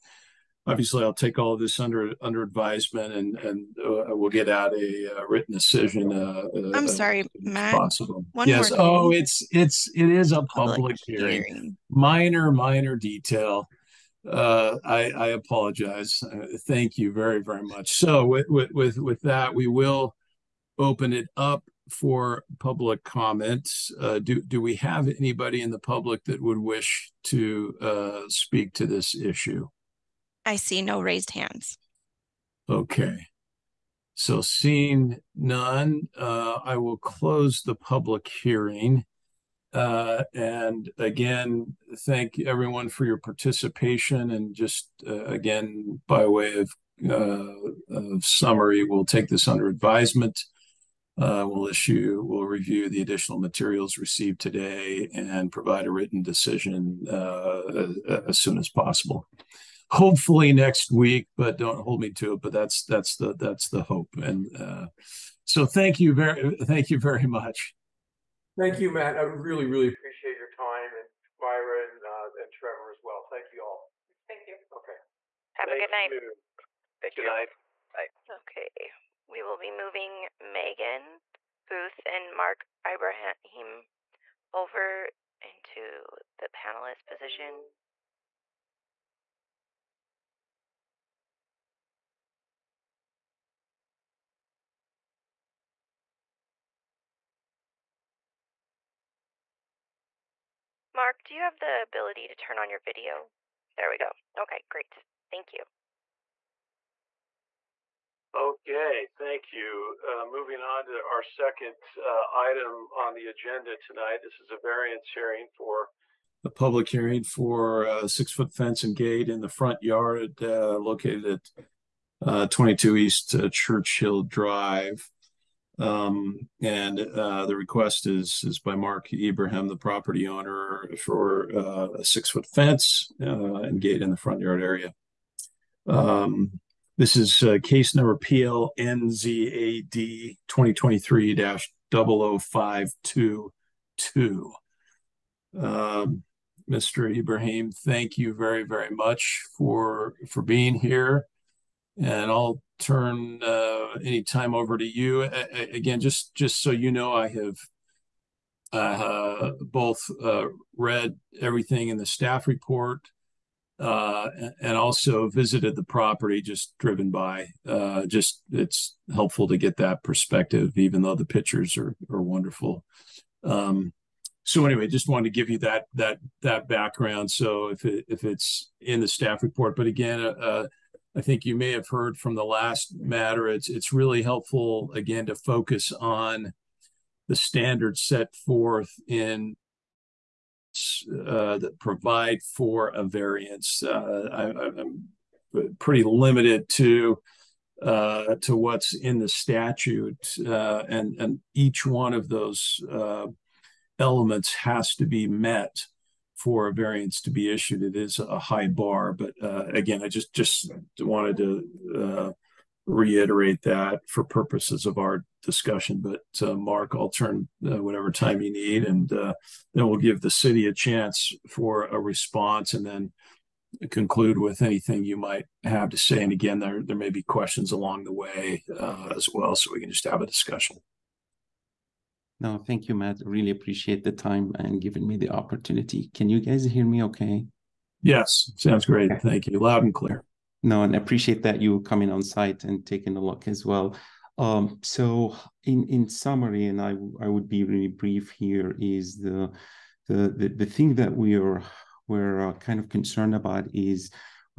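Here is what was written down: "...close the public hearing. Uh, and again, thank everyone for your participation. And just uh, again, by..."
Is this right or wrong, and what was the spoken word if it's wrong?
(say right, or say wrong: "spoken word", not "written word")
right.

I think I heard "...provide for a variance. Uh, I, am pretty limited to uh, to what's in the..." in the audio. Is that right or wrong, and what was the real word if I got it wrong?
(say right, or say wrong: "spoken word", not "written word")
right.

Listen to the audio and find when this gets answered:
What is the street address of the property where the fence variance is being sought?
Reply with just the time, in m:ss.
2:02.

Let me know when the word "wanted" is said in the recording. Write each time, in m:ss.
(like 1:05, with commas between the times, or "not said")
2:55, 3:30.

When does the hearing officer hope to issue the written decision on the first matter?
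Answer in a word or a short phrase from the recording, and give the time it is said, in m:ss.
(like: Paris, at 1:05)
Next week, at 1:00.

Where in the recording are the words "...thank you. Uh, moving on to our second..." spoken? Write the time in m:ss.
1:49.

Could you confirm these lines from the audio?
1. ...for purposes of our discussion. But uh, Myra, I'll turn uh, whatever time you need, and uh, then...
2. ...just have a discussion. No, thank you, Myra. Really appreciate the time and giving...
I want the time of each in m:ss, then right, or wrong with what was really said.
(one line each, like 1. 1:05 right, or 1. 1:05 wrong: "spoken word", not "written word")
1. 3:34 wrong: "Mark", not "Myra"
2. 3:49 wrong: "Matt", not "Myra".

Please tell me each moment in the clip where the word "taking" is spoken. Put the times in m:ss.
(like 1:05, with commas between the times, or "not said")
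4:02.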